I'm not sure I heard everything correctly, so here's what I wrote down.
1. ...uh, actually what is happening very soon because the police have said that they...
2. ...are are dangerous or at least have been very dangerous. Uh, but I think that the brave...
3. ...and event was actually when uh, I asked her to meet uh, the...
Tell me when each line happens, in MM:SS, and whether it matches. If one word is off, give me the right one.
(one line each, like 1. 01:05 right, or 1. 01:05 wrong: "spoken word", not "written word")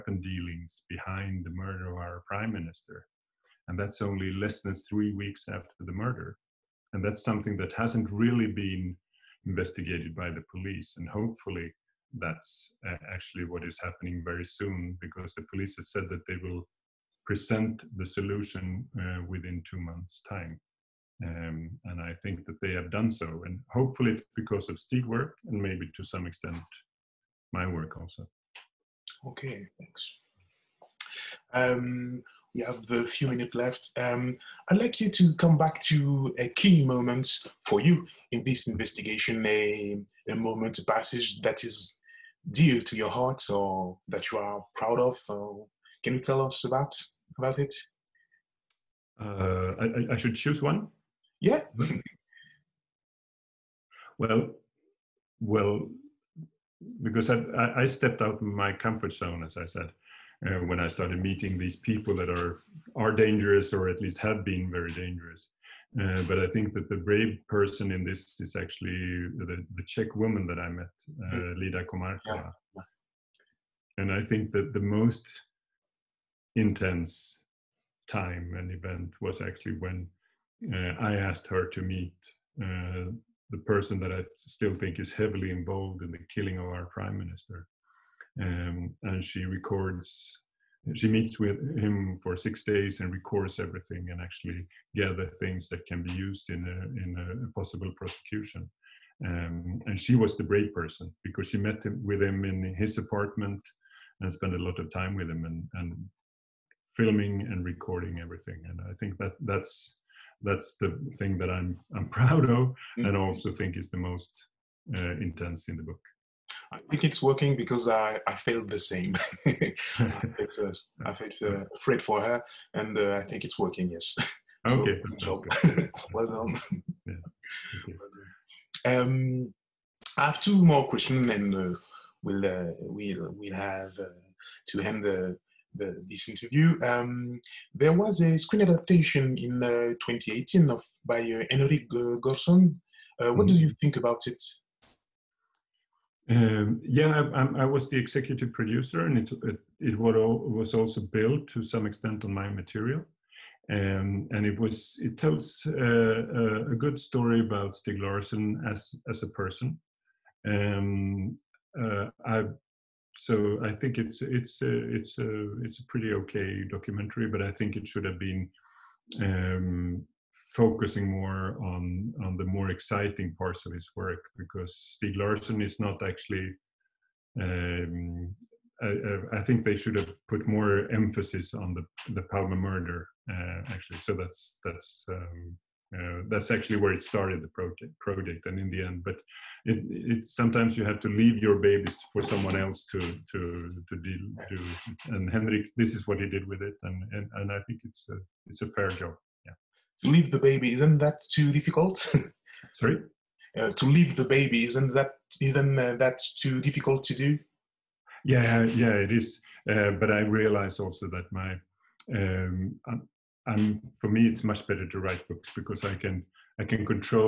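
1. 00:12 right
2. 01:02 right
3. 01:18 right.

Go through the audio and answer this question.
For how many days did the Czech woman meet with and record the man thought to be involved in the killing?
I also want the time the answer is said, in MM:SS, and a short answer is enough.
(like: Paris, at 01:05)
6, at 01:32.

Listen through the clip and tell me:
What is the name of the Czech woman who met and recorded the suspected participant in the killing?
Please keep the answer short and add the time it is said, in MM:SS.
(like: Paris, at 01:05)
Lida Komarkova, at 01:11.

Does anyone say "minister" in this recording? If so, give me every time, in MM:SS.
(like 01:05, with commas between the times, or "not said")
00:02, 01:27.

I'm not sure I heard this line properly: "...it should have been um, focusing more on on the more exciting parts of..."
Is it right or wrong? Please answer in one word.
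right.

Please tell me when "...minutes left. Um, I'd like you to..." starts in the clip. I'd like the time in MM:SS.
00:33.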